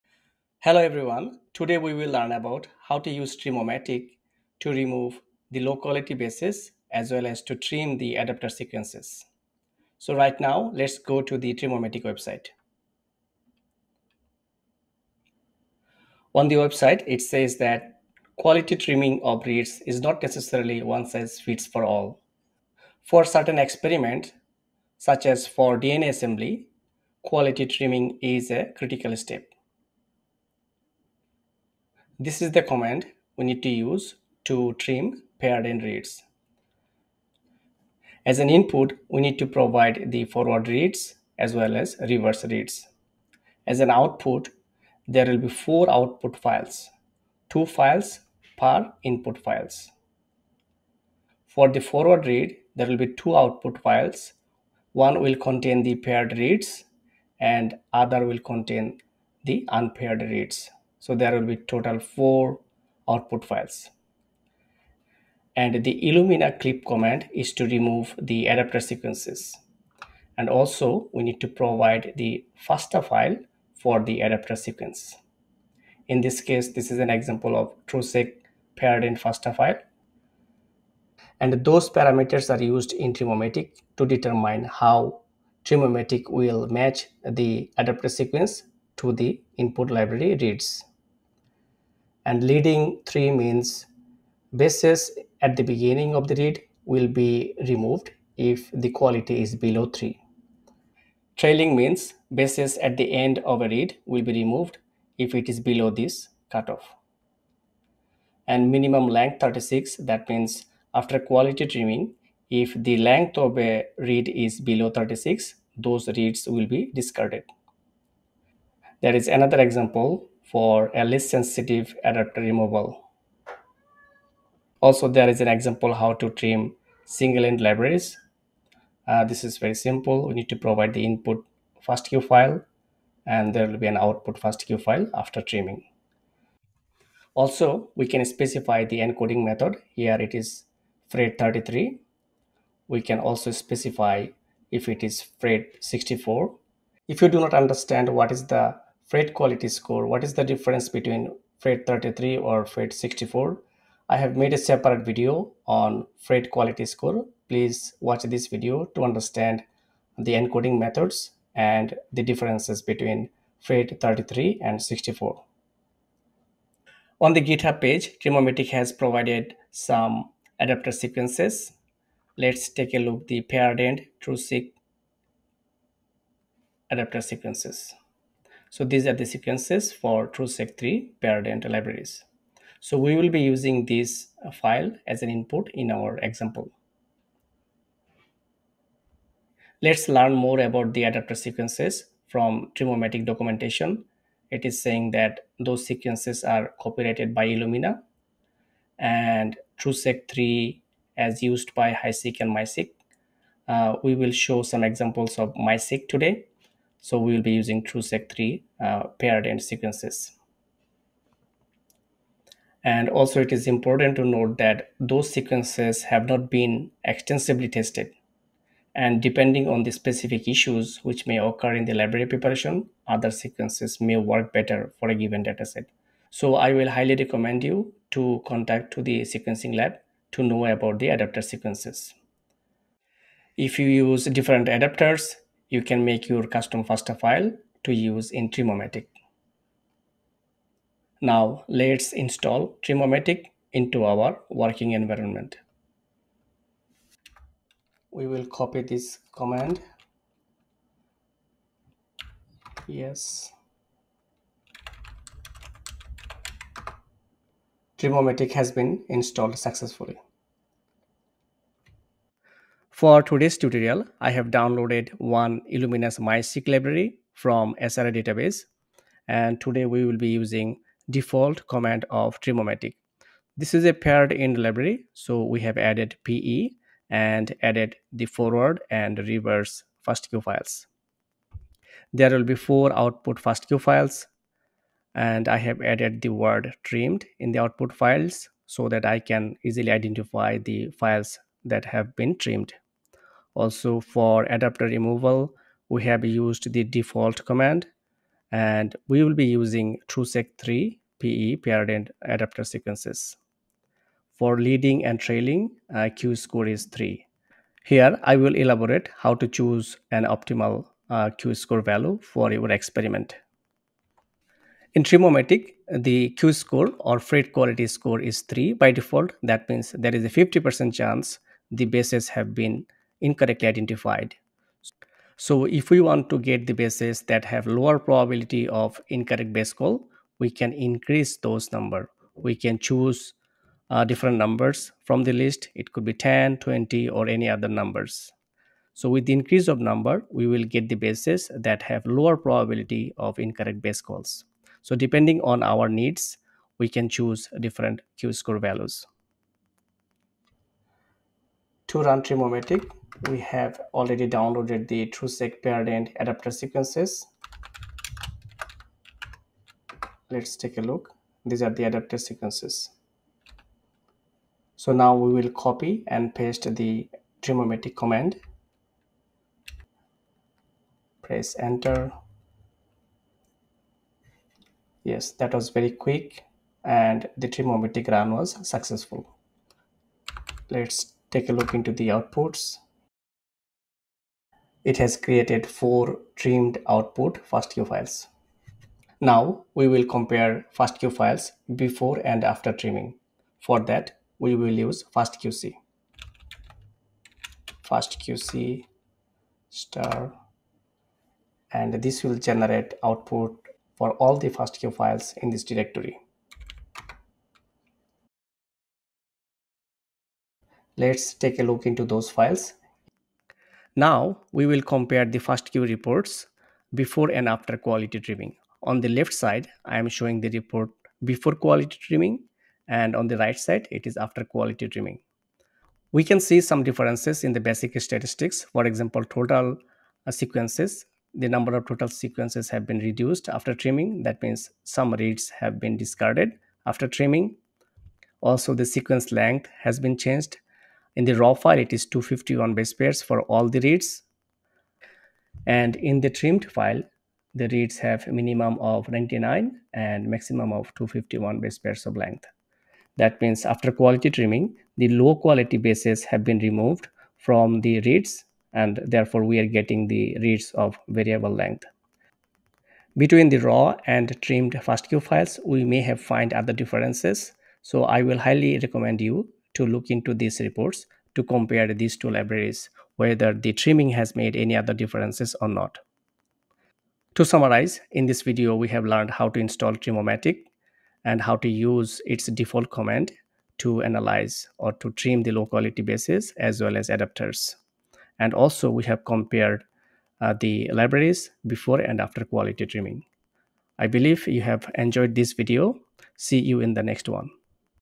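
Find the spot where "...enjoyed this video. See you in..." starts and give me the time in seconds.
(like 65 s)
494 s.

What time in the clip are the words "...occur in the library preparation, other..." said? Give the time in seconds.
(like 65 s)
221 s.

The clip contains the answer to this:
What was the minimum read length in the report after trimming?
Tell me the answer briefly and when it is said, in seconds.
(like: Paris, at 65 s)
99 base pairs, at 449 s.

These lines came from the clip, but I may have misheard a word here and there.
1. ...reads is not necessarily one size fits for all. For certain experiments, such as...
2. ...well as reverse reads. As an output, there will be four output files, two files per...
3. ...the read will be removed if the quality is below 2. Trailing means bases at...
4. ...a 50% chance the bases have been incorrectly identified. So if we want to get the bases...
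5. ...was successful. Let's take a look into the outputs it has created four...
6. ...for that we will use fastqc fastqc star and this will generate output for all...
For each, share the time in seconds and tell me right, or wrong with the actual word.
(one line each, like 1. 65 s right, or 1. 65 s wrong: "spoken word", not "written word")
1. 19 s right
2. 41 s right
3. 96 s wrong: "3", not "2"
4. 320 s right
5. 378 s right
6. 393 s right.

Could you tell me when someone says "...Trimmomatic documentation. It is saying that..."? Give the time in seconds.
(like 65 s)
192 s.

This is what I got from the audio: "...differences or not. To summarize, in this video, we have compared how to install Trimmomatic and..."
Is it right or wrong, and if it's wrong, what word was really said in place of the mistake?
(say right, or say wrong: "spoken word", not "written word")
wrong: "learned", not "compared".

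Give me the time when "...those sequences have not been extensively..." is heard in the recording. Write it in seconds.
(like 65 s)
214 s.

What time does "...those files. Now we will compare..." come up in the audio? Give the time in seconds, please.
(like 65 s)
412 s.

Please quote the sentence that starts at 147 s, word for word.
If you do not understand what is the Phred quality score, what is the difference between Phred 33 or Phred 64?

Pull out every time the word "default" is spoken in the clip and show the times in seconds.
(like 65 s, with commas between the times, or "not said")
271 s, 296 s, 318 s, 482 s.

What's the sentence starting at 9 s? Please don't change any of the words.
So right now, let's go to the Trimmomatic website.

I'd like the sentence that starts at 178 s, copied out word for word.
So these are the sequences for TruSeq3 paired parent libraries.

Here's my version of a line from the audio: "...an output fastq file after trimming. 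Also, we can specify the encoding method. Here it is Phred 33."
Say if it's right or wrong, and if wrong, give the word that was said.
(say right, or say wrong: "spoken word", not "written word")
right.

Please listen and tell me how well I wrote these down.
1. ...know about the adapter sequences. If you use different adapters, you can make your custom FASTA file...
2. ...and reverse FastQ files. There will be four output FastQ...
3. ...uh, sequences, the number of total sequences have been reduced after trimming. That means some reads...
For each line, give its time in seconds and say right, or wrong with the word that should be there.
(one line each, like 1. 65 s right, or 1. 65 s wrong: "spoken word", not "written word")
1. 230 s right
2. 278 s right
3. 430 s right.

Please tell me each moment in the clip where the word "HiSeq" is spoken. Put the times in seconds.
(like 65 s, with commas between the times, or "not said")
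201 s.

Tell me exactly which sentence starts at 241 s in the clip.
Now let's install Trimmomatic into our working environment.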